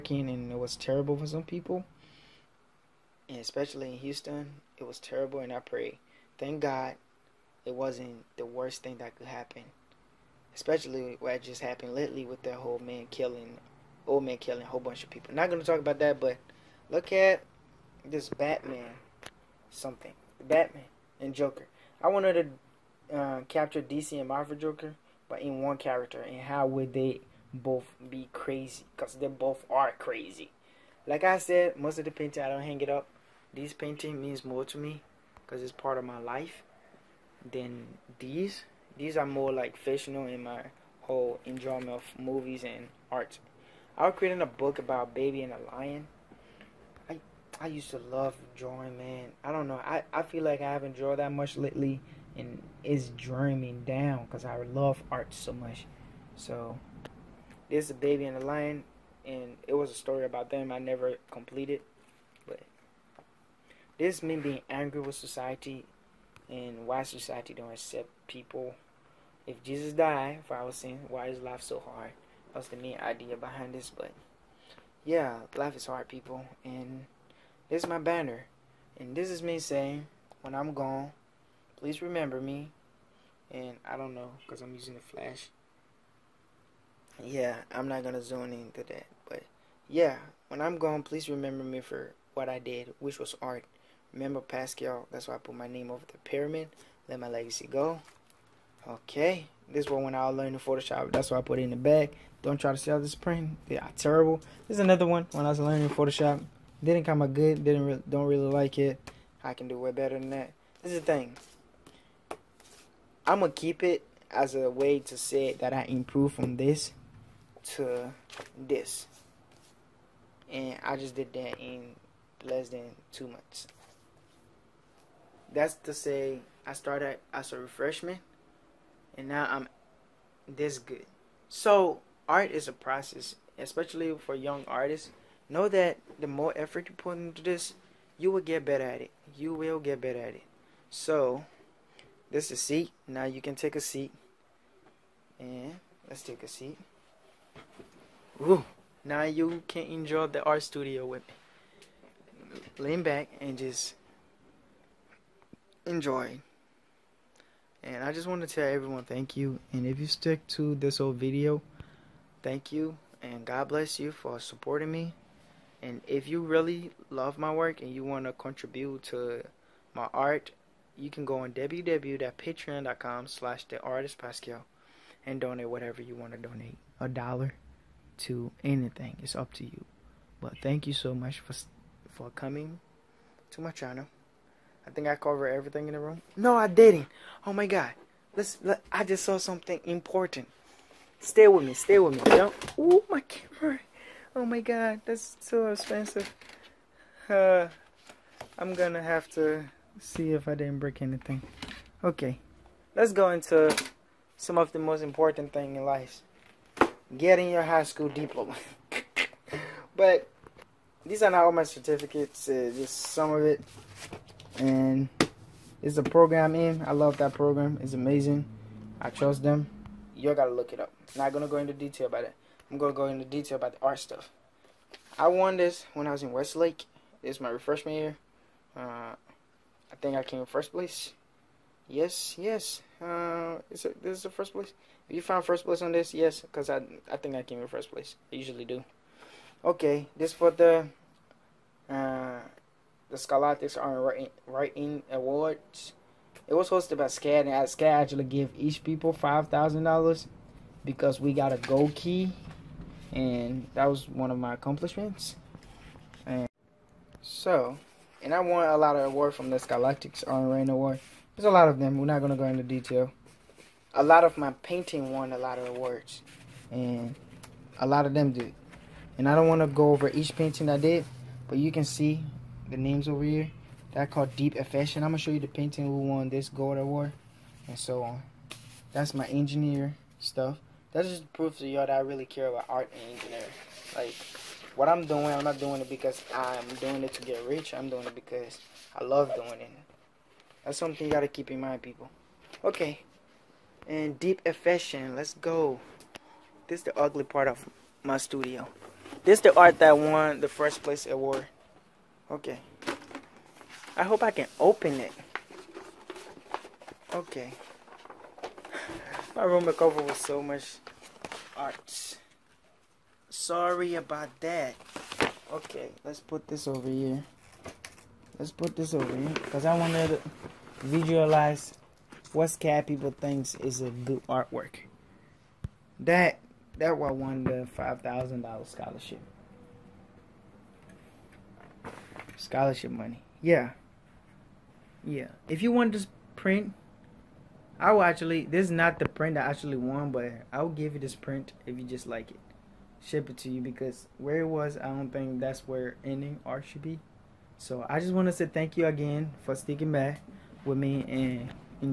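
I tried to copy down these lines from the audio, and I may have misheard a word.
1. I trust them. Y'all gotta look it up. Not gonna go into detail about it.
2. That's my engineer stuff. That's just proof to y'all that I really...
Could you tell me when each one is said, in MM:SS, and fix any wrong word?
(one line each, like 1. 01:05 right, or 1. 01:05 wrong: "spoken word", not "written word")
1. 03:39 right
2. 04:38 right.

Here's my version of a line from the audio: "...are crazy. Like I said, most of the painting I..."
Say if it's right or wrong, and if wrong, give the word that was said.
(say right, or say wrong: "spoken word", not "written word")
right.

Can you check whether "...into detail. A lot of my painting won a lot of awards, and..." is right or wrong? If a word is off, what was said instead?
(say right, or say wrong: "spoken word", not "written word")
right.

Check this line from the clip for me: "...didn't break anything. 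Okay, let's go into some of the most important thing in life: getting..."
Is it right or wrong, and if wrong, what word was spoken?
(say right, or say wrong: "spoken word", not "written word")
right.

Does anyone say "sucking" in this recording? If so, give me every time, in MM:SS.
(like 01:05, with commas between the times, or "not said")
not said.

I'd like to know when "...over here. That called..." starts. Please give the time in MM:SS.
04:33.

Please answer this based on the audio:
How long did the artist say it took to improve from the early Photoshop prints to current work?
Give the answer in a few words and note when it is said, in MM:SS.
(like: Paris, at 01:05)
less than two months, at 02:02.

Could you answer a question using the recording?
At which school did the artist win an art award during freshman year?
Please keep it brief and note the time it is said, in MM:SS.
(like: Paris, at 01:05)
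Westlake, at 03:46.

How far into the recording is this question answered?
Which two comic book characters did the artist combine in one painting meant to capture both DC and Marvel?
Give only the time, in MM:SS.
00:20.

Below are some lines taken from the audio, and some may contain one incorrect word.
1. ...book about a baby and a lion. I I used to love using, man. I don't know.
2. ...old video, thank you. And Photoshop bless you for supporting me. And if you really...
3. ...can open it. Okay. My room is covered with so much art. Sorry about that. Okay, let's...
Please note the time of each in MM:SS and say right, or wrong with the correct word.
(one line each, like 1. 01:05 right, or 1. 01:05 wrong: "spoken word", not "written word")
1. 00:44 wrong: "drawing", not "using"
2. 02:40 wrong: "God", not "Photoshop"
3. 05:04 right.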